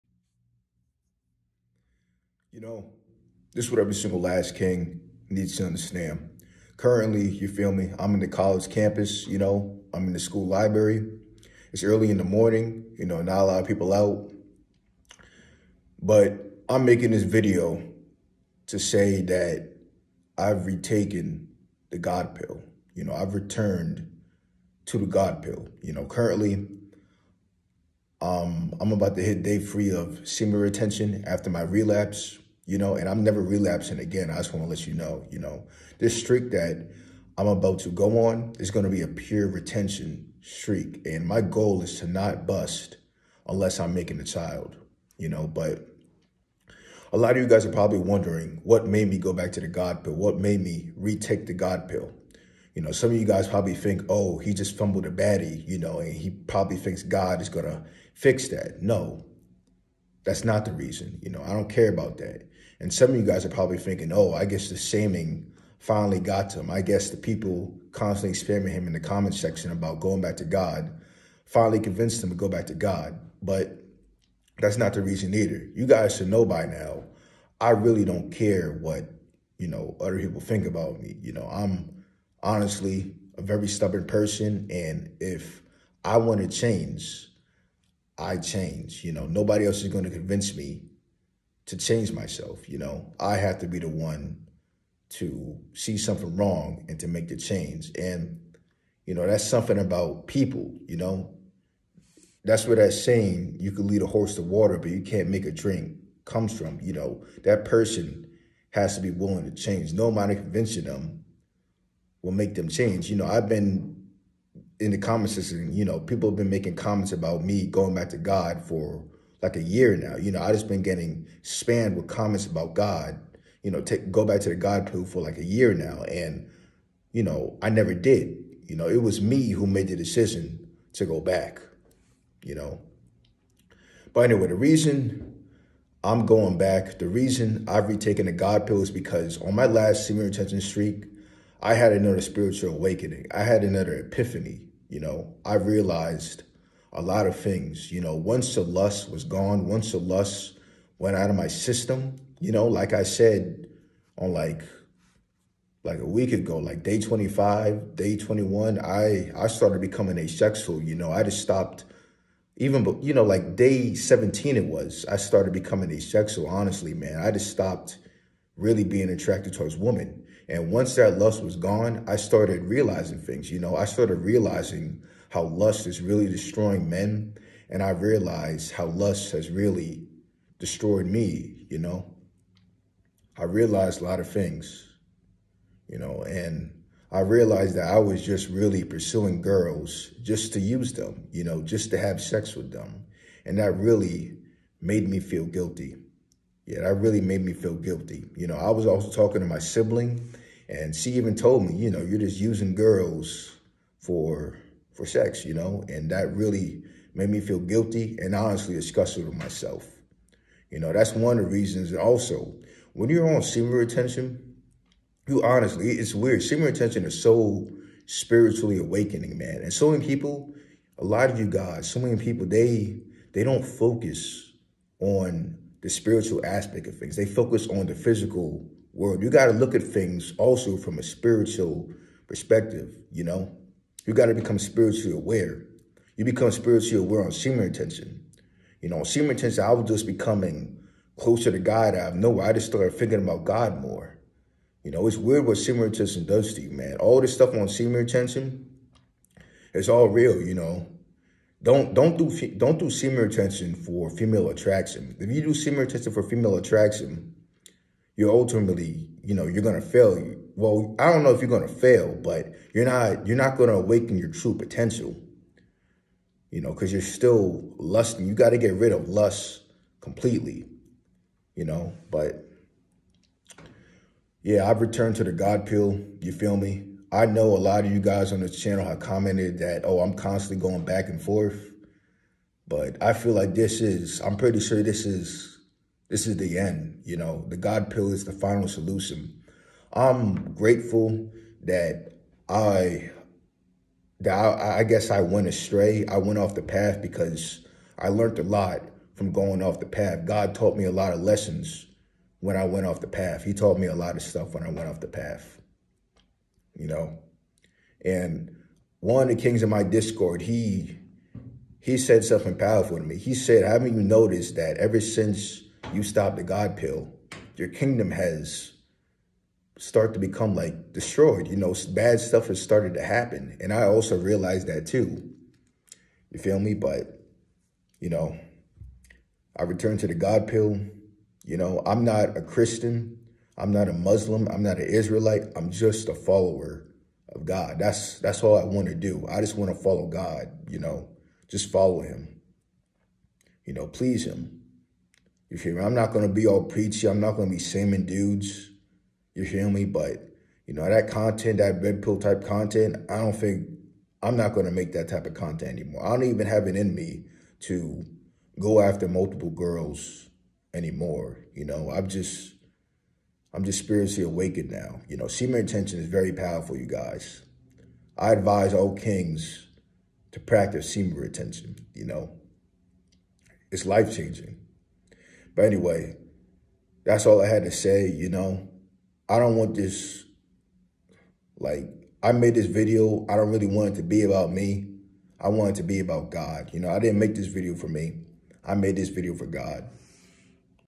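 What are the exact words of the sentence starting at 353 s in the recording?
I don't think I'm not going to make that type of content anymore.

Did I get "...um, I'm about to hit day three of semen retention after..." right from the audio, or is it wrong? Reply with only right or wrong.
right.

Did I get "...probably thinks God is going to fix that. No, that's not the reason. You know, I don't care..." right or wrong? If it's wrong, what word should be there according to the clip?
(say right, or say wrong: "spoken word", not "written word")
right.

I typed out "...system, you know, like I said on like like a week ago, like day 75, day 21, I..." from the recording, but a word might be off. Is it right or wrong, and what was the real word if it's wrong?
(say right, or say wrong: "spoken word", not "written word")
wrong: "25", not "75".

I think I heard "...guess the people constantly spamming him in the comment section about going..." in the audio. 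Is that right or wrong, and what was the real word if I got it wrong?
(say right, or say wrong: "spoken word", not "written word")
right.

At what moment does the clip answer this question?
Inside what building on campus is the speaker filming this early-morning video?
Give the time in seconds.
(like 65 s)
10 s.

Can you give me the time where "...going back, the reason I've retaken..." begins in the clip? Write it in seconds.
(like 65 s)
136 s.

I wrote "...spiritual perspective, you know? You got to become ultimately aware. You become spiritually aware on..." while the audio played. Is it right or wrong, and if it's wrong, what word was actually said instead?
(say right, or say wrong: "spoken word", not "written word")
wrong: "spiritually", not "ultimately".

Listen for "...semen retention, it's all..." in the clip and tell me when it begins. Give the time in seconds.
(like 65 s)
247 s.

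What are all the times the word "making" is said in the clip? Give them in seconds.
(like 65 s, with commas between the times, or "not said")
16 s, 43 s, 116 s.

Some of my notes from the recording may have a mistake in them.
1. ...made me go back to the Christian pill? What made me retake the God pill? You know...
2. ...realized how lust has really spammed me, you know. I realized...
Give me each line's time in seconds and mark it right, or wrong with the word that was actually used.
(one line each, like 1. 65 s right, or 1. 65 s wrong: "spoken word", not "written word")
1. 48 s wrong: "God", not "Christian"
2. 177 s wrong: "destroyed", not "spammed".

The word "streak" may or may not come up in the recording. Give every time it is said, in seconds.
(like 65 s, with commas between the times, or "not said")
36 s, 40 s, 140 s.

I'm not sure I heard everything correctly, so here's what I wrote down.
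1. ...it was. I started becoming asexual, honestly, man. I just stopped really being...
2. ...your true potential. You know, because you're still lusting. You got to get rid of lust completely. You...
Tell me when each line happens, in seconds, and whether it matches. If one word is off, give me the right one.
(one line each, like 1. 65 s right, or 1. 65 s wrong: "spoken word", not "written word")
1. 164 s right
2. 264 s right.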